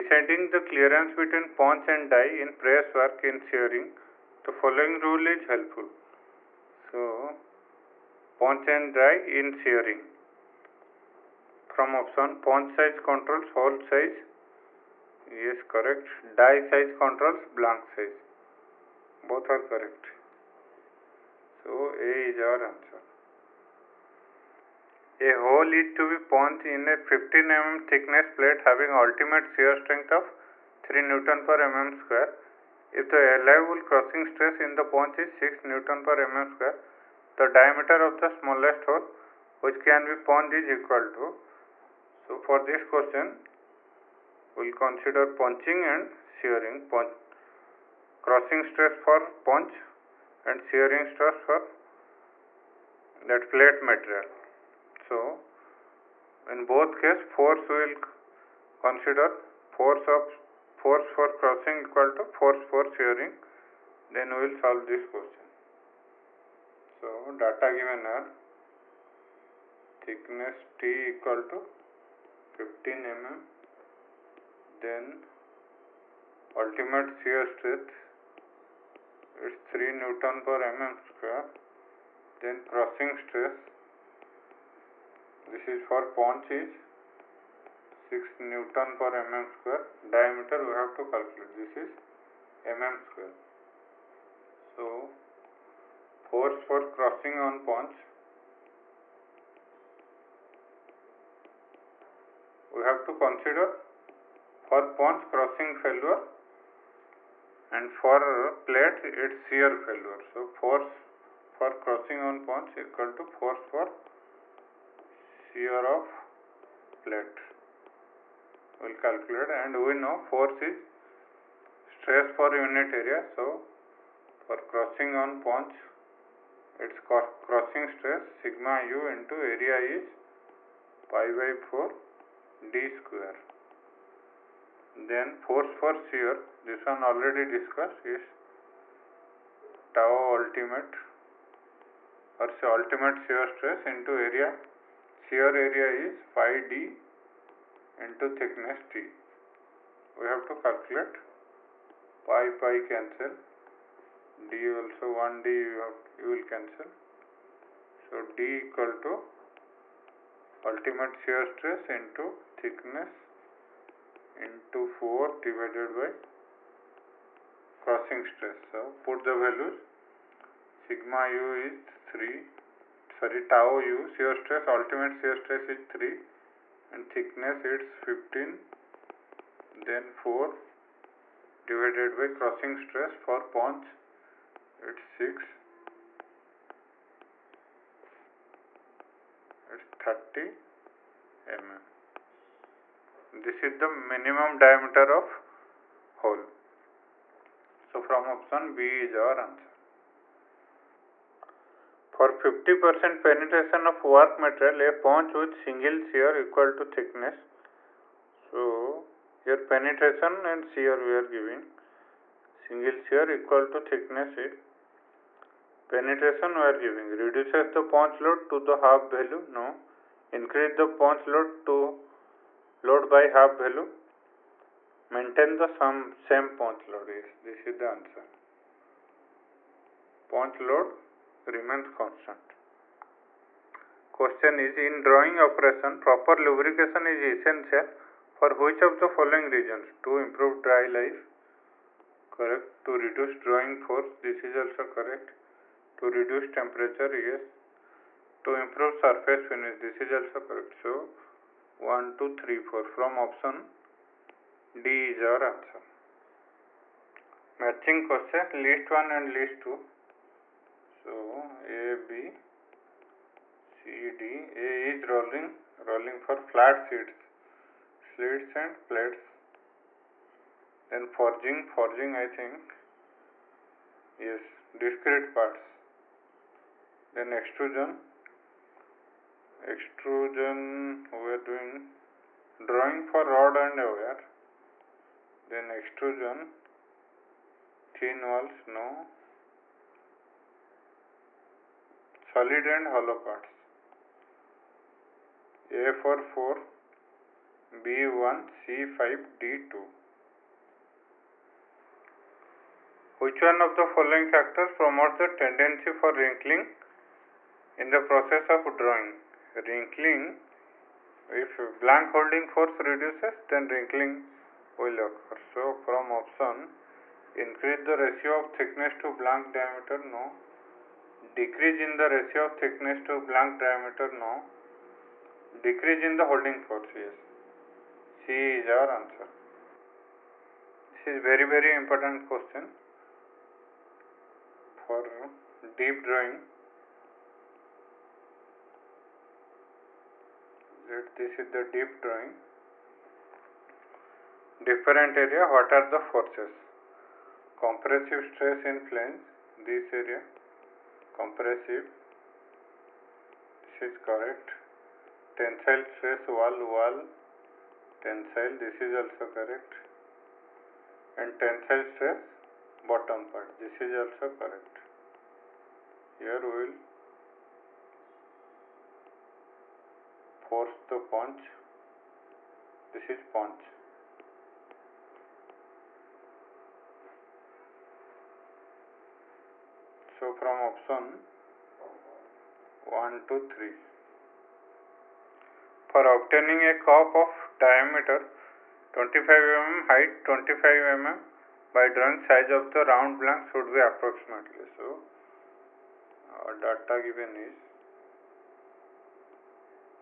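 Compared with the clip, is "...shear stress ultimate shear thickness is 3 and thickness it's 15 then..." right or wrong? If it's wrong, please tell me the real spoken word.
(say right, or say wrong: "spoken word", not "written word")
wrong: "stress", not "thickness".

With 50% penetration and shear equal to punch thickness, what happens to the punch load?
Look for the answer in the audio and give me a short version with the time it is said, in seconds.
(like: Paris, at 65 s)
remains constant, at 230 s.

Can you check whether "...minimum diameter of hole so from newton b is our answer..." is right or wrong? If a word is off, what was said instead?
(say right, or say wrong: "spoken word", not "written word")
wrong: "option", not "newton".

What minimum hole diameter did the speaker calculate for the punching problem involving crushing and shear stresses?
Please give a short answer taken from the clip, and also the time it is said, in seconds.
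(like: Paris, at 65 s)
30 mm, at 189 s.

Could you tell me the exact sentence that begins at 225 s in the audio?
Maintain the sum, same punch load.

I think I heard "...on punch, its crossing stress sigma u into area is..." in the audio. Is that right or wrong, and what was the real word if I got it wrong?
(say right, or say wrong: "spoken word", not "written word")
right.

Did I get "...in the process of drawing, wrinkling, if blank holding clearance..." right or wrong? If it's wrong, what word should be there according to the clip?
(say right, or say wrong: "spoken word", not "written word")
wrong: "force", not "clearance".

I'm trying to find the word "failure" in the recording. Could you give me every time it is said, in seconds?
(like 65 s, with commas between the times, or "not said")
105 s, 109 s.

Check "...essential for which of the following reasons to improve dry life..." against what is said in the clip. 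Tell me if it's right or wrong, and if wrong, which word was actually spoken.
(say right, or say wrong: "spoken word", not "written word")
right.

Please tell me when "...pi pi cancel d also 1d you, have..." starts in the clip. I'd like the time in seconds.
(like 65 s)
152 s.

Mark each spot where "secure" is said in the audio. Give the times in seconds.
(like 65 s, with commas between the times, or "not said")
not said.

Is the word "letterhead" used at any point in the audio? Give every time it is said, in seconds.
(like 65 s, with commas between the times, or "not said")
not said.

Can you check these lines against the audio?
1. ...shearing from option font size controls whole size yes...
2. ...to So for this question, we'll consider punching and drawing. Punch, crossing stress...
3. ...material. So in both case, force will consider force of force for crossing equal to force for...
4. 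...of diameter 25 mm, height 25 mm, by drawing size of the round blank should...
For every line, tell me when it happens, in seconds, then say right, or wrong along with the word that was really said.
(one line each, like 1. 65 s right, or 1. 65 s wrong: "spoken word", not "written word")
1. 9 s right
2. 41 s wrong: "shearing", not "drawing"
3. 53 s right
4. 387 s right.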